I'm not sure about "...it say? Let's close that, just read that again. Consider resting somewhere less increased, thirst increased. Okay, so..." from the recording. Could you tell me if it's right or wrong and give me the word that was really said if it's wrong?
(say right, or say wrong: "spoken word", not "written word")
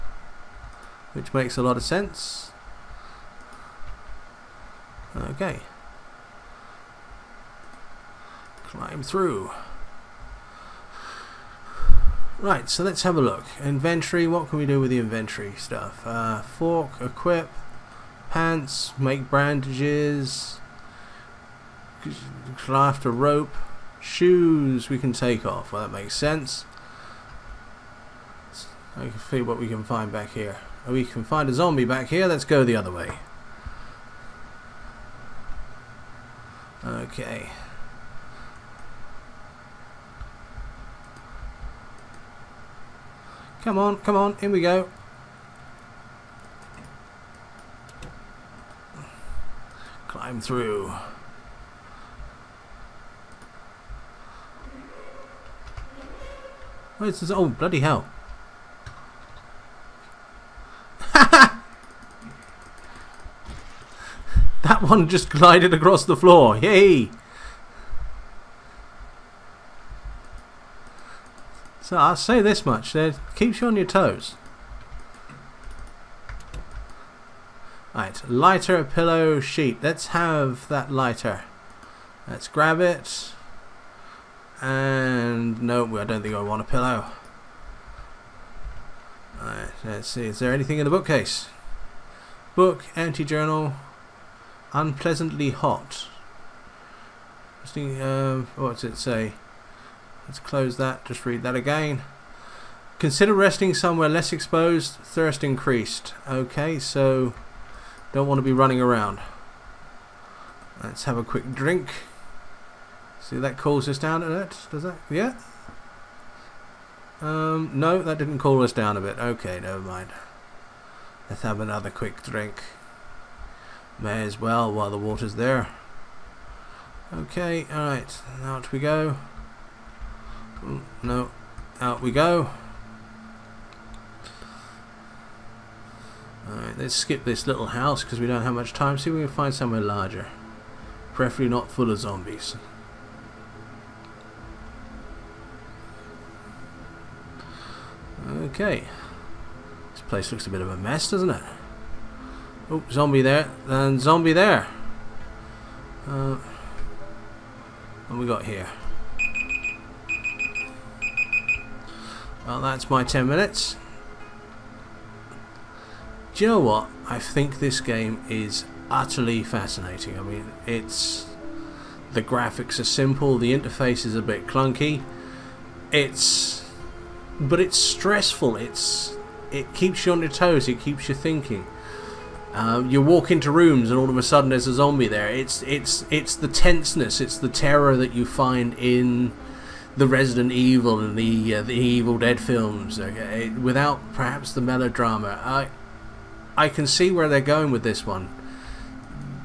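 wrong: "exposed", not "increased".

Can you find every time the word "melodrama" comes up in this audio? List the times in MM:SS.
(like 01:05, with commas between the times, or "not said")
03:14.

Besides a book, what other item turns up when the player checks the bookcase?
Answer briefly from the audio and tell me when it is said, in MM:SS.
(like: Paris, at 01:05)
Empty journal, at 01:32.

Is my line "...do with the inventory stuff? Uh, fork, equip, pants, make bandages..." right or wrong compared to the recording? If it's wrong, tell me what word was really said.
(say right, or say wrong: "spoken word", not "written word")
right.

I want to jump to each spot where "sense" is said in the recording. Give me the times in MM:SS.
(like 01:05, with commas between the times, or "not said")
00:01, 00:26.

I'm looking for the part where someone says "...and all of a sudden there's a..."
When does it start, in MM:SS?
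03:03.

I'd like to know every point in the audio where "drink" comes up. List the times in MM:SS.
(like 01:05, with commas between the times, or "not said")
01:51, 02:02.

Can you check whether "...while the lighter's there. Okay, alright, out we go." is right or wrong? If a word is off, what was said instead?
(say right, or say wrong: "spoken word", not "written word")
wrong: "water", not "lighter".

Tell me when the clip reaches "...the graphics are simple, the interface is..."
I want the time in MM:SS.
02:52.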